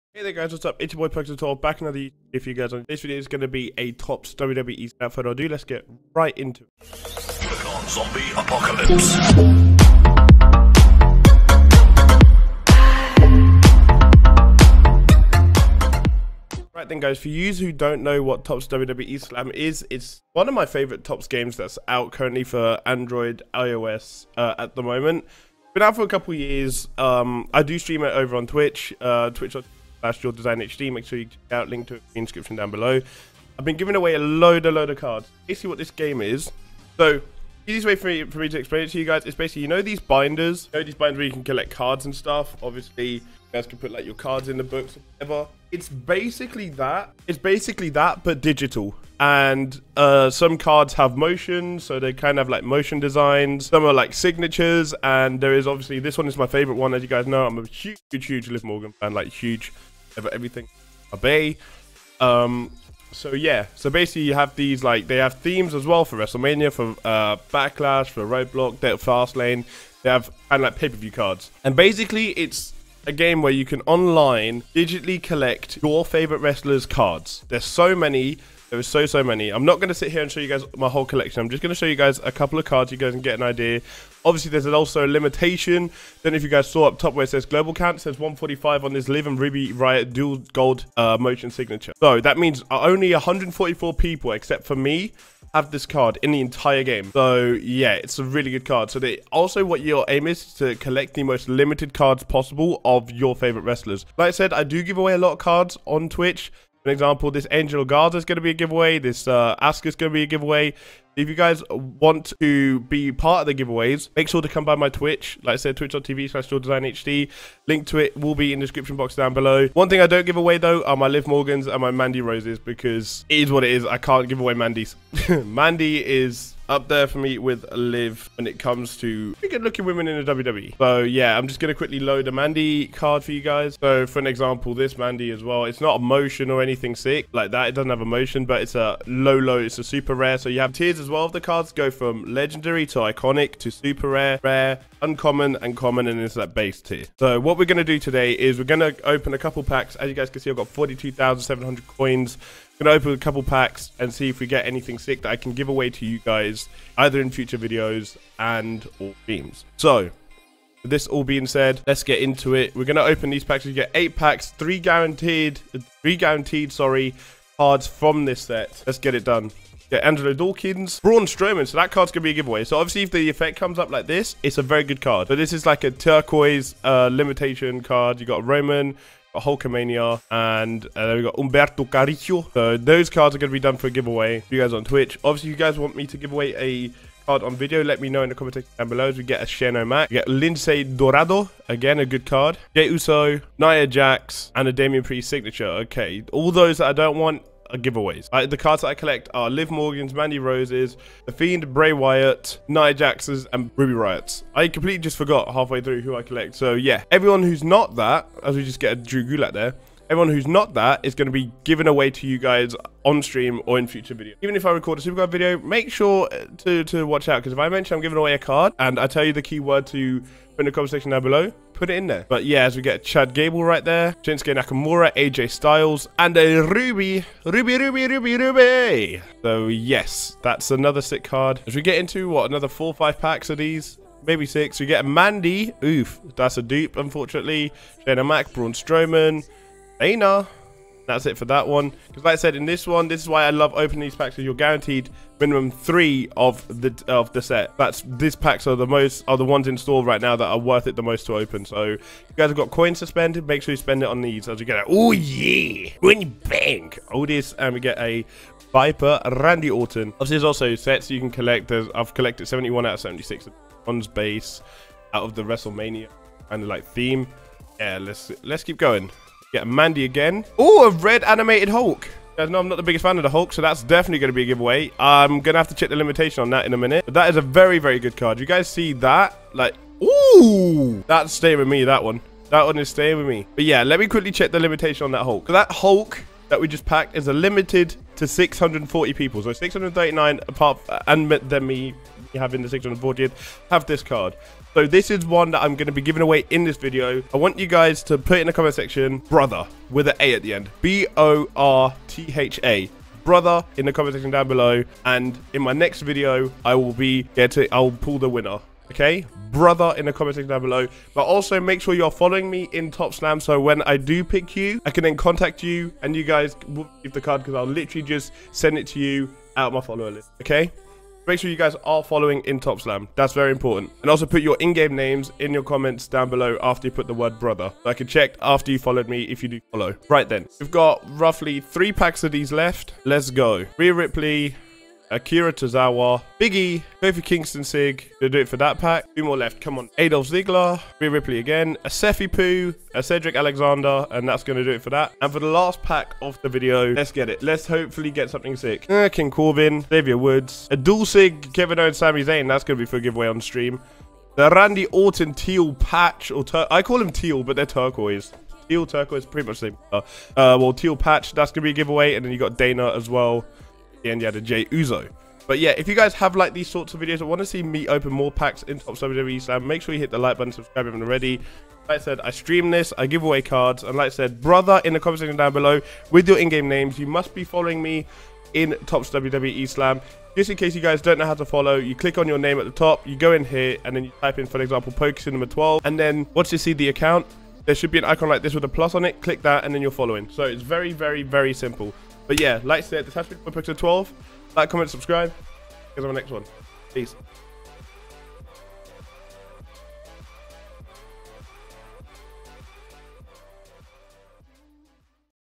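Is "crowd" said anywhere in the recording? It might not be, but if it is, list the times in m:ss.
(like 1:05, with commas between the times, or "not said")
not said.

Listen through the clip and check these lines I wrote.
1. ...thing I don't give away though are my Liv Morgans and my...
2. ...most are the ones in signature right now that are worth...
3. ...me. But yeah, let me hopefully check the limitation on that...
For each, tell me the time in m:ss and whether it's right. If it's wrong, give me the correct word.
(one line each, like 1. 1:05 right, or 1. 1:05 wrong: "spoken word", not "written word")
1. 1:59 right
2. 4:08 wrong: "store", not "signature"
3. 4:43 wrong: "quickly", not "hopefully".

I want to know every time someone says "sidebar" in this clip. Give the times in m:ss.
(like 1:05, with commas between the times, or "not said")
not said.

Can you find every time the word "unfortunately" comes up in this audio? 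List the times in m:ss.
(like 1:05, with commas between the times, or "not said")
3:56.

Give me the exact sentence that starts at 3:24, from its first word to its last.
I completely just forgot halfway through who I collect.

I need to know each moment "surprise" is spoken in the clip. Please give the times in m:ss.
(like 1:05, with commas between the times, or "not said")
not said.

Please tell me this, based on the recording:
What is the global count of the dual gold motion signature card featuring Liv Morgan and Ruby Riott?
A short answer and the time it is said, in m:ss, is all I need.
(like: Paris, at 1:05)
145, at 1:28.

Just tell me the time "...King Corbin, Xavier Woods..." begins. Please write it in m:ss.
5:49.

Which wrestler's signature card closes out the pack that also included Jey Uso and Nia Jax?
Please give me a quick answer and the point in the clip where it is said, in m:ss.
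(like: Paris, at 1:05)
Damian Priest, at 3:14.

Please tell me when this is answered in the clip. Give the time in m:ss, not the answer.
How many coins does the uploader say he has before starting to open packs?
2:30.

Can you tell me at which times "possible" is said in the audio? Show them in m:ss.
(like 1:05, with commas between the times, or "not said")
1:42.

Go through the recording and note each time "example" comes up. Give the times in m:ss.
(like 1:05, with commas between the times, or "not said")
1:46, 2:14, 6:24.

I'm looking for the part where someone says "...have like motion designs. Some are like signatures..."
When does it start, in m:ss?
0:52.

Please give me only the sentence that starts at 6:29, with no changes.
Click that, and then you're following.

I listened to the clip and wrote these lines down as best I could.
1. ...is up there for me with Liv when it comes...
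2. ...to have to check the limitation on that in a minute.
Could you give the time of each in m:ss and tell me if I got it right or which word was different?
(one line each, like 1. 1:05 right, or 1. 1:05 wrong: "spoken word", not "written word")
1. 2:06 right
2. 4:35 right.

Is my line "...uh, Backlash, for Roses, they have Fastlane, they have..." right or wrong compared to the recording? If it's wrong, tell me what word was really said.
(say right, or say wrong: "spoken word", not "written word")
wrong: "Roadblock", not "Roses".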